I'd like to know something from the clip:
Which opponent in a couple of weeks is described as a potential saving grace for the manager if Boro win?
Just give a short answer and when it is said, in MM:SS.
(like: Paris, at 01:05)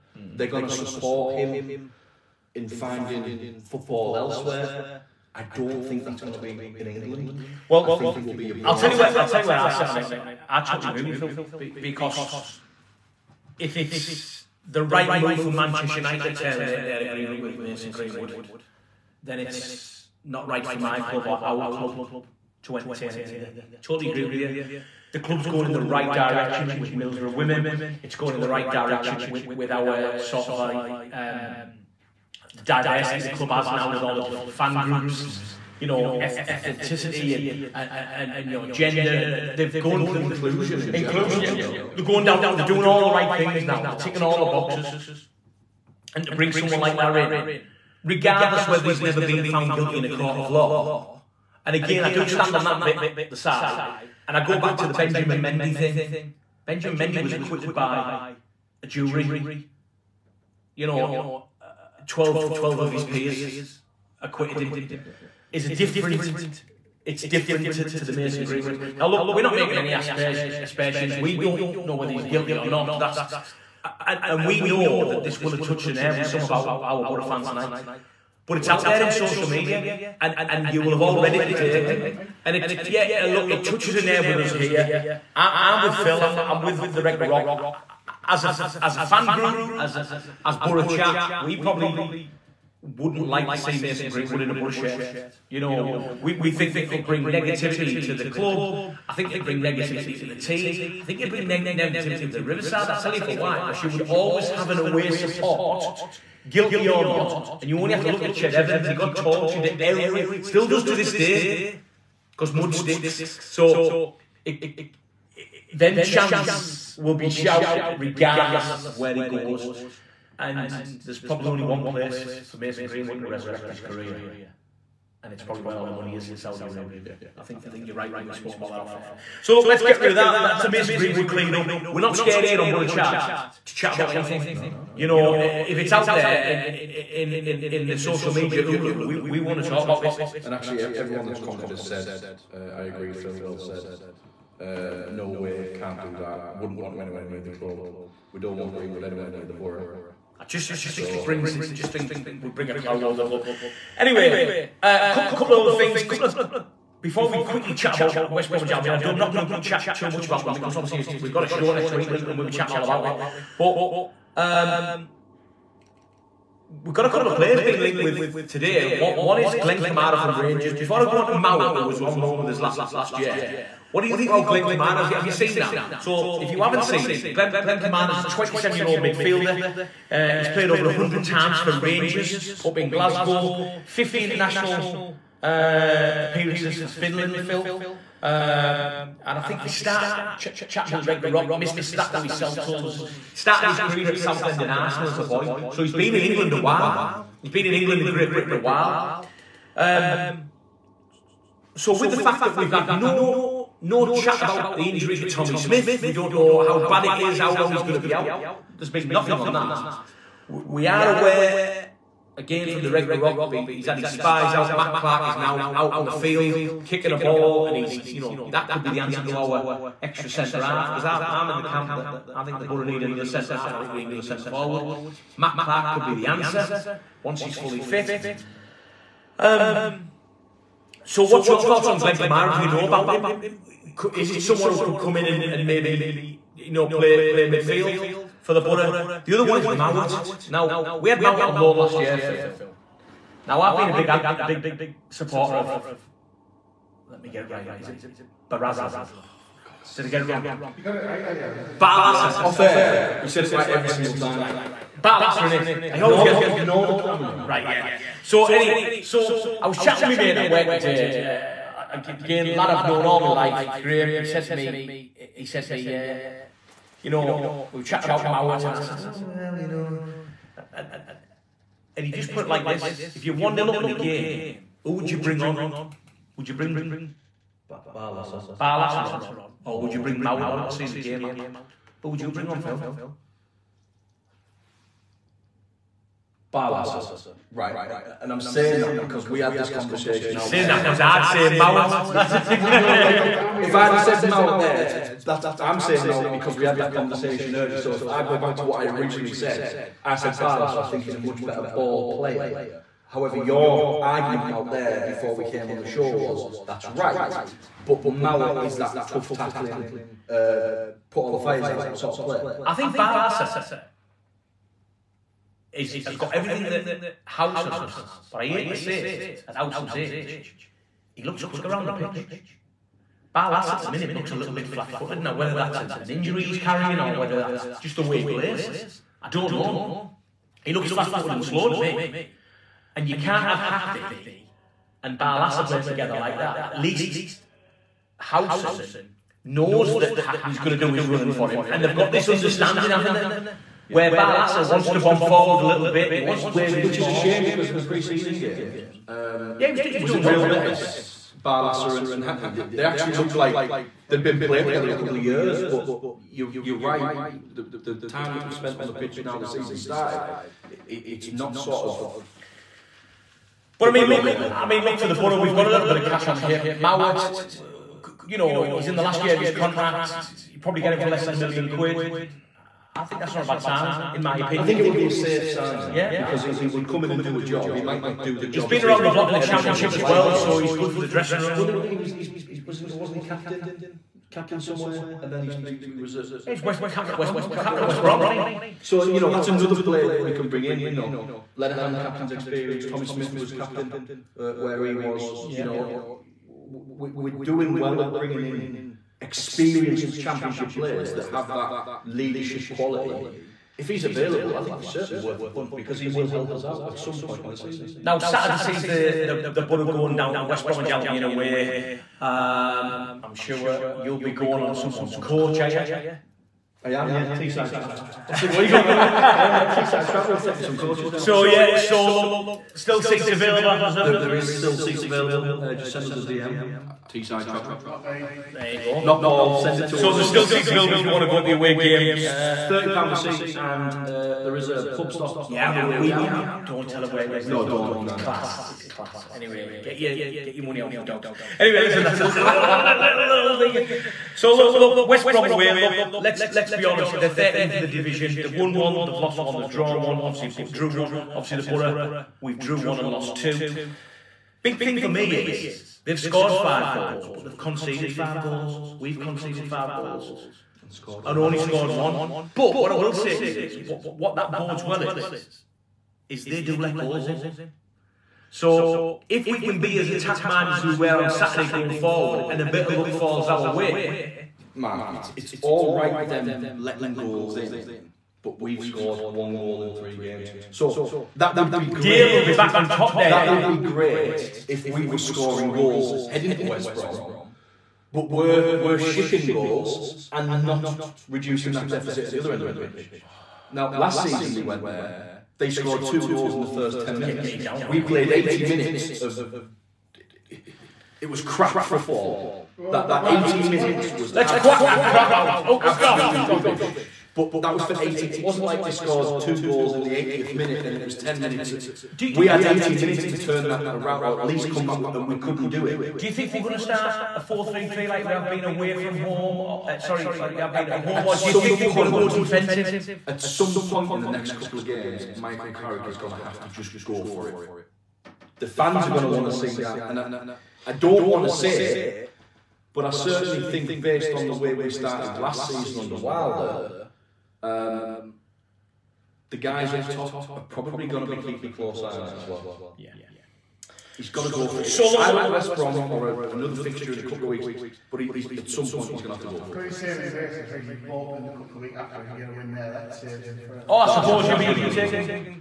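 Bolton, at 09:10.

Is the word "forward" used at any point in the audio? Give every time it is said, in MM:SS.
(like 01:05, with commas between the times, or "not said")
03:44, 05:45, 07:51.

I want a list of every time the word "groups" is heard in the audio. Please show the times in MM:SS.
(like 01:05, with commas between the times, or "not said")
00:34, 01:29.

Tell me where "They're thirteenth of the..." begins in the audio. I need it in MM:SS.
07:27.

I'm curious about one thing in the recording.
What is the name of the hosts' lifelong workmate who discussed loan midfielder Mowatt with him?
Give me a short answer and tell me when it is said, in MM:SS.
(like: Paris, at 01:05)
Graham, at 04:23.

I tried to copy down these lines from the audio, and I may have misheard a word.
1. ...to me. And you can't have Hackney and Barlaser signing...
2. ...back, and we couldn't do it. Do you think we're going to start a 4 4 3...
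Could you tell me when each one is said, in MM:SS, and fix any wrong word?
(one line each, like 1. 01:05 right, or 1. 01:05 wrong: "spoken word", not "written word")
1. 05:31 wrong: "playing", not "signing"
2. 08:34 wrong: "3", not "4".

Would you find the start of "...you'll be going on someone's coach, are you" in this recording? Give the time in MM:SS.
06:53.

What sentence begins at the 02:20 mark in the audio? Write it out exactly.
And actually, everyone that's commented has said, uh, I agree, Phil.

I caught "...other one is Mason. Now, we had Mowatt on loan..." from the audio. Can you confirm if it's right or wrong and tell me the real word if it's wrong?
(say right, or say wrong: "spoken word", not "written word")
wrong: "Mowatt", not "Mason".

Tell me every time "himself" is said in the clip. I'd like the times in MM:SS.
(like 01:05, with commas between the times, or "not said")
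03:12.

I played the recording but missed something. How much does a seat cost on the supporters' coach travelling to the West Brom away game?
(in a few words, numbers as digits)
£30.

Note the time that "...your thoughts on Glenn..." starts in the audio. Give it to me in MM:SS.
03:51.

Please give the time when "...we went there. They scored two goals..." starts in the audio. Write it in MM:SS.
08:14.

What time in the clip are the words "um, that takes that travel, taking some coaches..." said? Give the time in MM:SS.
06:59.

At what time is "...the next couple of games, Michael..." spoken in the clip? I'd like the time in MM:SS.
08:44.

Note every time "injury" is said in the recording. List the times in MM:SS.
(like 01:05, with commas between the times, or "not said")
03:24, 05:26.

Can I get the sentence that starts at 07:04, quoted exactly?
There, there is still seats available.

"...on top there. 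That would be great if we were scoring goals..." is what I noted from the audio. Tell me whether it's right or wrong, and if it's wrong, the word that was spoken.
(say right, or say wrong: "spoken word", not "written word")
right.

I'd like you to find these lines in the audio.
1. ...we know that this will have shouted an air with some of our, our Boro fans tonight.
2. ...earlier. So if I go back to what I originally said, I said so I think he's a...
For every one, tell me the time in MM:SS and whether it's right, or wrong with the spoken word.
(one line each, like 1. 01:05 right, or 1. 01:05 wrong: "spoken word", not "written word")
1. 01:14 wrong: "touched", not "shouted"
2. 04:57 right.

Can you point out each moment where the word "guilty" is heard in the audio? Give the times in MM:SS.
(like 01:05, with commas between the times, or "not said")
00:49, 01:12, 01:46.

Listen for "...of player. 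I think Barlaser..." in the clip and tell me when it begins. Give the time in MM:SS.
05:12.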